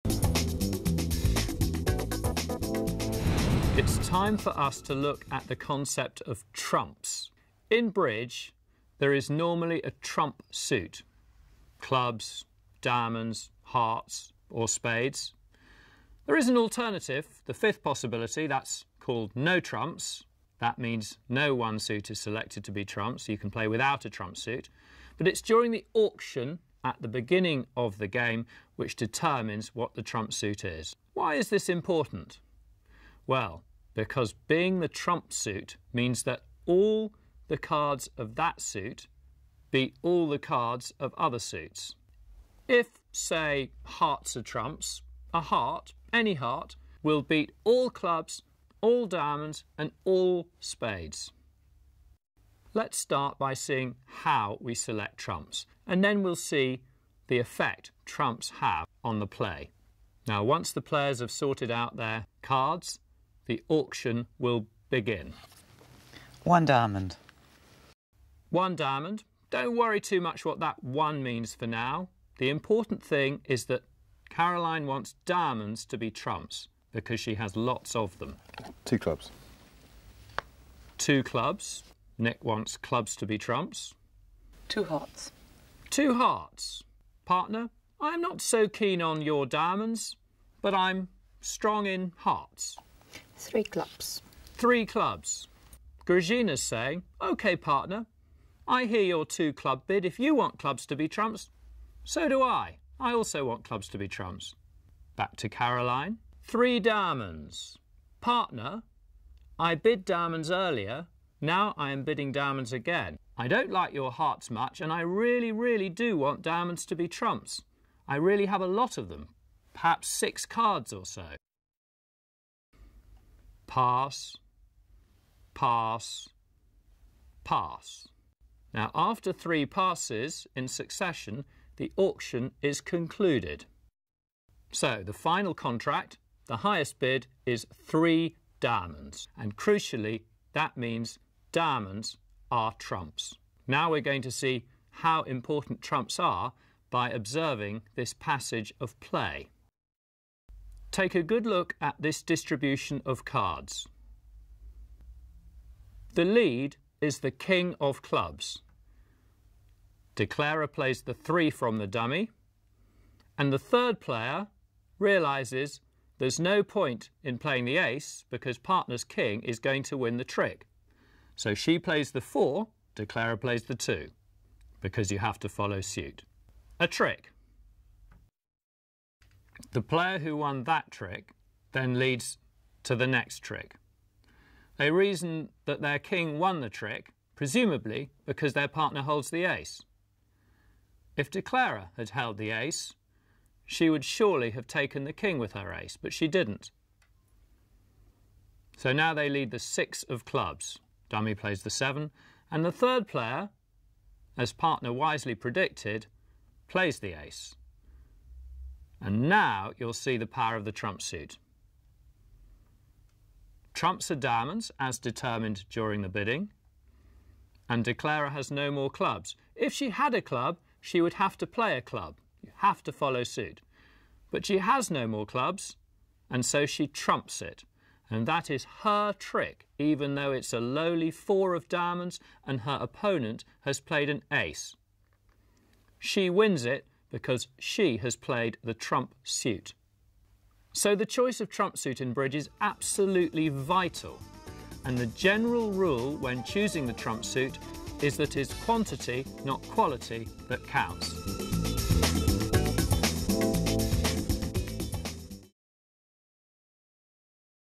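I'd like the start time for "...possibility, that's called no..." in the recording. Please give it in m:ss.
0:17.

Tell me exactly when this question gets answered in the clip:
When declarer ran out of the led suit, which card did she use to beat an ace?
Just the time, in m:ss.
3:51.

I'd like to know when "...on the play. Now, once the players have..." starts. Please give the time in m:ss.
0:59.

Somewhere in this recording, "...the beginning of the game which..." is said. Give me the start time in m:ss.
0:27.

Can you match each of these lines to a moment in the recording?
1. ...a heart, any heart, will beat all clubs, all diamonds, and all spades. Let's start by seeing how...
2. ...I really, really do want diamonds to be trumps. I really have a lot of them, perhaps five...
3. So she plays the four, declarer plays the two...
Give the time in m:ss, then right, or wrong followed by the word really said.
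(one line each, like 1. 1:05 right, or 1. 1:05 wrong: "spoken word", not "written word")
1. 0:45 right
2. 1:54 wrong: "six", not "five"
3. 2:51 right.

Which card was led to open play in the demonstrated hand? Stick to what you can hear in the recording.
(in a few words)
King of clubs.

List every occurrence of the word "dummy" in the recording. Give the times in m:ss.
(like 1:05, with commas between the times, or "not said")
2:41, 3:21.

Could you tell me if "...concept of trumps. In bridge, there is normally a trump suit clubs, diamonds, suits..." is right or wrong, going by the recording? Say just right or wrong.
wrong.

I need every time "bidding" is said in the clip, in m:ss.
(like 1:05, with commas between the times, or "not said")
1:52, 3:36.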